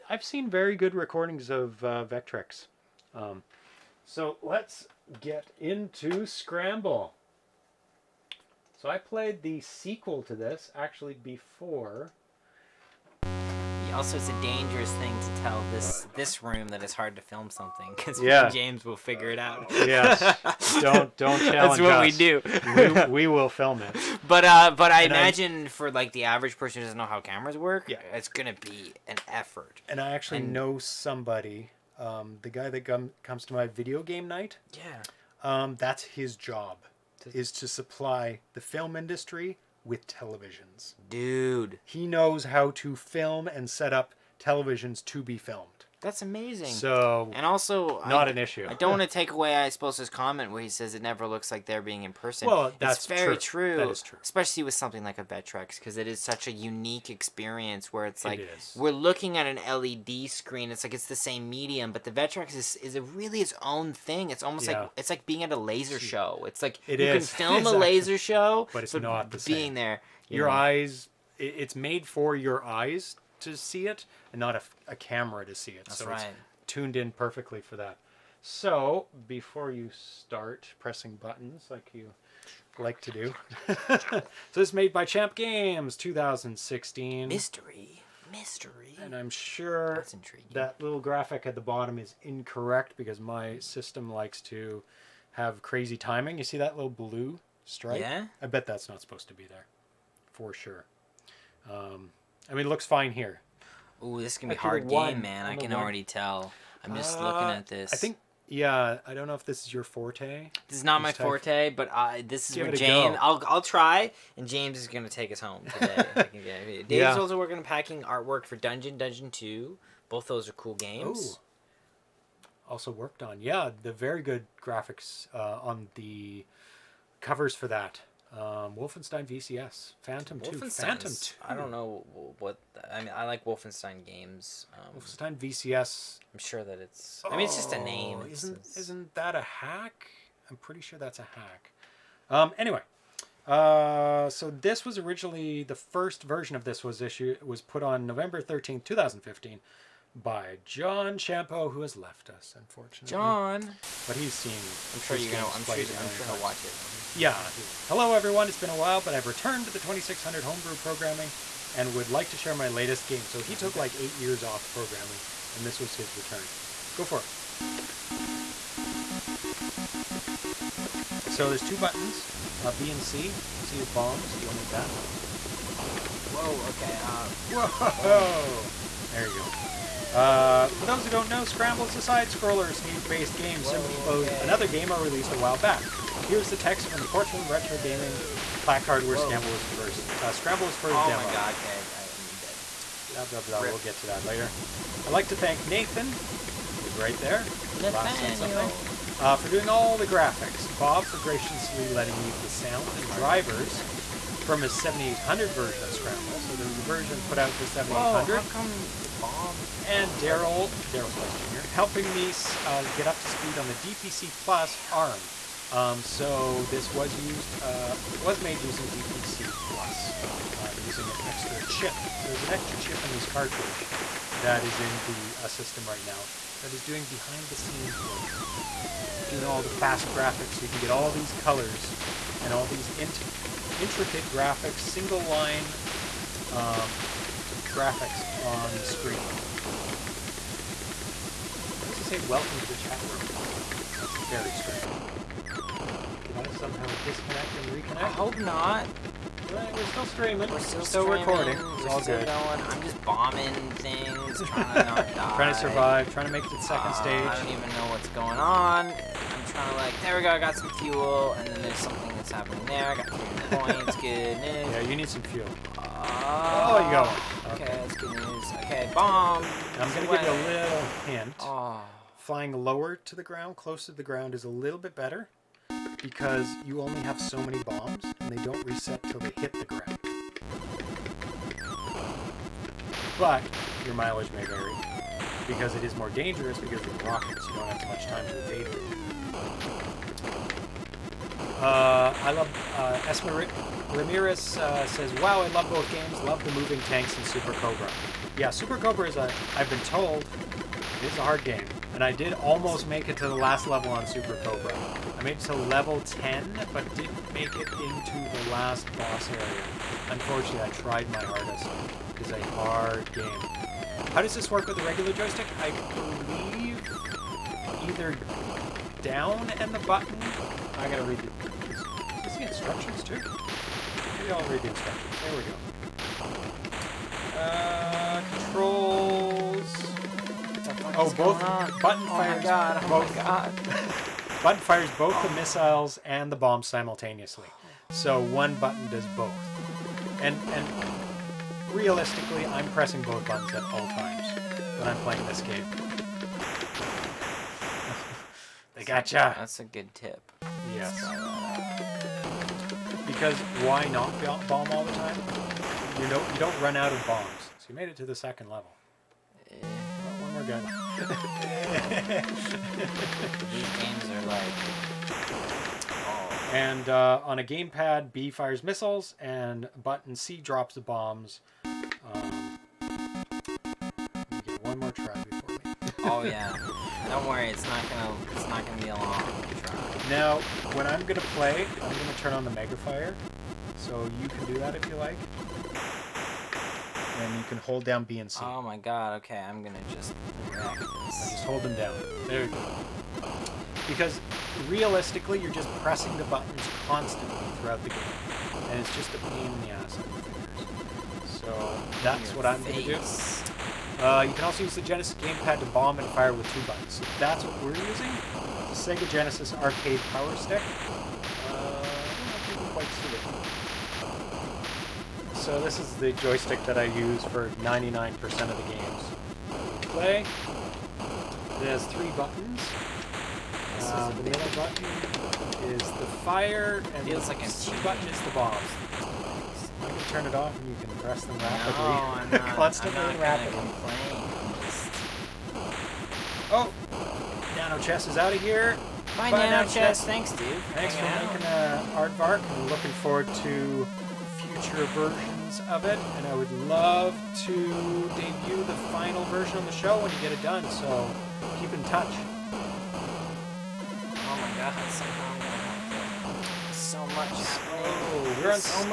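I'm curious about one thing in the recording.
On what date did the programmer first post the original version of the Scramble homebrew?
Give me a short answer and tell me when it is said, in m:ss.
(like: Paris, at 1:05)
November 13, 2015, at 2:28.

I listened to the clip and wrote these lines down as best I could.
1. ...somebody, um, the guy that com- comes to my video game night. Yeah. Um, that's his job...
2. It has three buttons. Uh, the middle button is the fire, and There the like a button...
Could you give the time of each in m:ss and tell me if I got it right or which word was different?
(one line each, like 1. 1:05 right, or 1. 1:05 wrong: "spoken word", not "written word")
1. 0:30 right
2. 7:00 wrong: "Feels", not "There".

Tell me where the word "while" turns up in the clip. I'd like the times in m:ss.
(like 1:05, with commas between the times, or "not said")
2:38, 3:05.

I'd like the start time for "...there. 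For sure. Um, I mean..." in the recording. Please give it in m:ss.
1:39.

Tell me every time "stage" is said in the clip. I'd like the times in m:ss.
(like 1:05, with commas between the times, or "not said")
3:02, 4:16.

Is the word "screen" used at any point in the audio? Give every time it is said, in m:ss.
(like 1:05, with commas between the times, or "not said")
1:00, 3:58.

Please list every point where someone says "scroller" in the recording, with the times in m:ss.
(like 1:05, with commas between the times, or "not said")
3:02.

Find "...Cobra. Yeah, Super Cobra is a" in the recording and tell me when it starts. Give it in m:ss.
4:57.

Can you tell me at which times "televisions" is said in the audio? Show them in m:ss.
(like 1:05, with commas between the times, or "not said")
0:40, 0:44.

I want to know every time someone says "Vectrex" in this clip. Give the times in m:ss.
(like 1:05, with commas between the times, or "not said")
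0:02, 0:55, 1:02.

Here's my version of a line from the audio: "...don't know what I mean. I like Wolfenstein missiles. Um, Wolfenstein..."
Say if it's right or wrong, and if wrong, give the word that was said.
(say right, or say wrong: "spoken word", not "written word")
wrong: "games", not "missiles".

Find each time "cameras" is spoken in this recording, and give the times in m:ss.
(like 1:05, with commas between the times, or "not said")
0:27, 1:14.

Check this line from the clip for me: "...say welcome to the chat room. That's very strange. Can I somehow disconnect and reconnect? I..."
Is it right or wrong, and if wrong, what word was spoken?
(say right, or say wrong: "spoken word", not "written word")
right.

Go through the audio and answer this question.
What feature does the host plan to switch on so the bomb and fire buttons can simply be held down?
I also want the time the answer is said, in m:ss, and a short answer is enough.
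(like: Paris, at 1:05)
Megafire, at 6:22.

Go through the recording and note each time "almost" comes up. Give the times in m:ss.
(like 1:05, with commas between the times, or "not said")
1:04, 5:02.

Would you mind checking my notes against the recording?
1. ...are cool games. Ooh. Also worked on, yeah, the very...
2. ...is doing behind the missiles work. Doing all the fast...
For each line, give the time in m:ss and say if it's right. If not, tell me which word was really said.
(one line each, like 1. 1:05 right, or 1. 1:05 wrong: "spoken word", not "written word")
1. 2:00 right
2. 3:46 wrong: "scenes", not "missiles".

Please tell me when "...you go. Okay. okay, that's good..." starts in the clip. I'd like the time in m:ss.
4:26.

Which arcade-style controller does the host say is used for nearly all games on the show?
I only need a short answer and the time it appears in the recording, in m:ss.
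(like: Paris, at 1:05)
Sega Genesis arcade power stick, at 6:48.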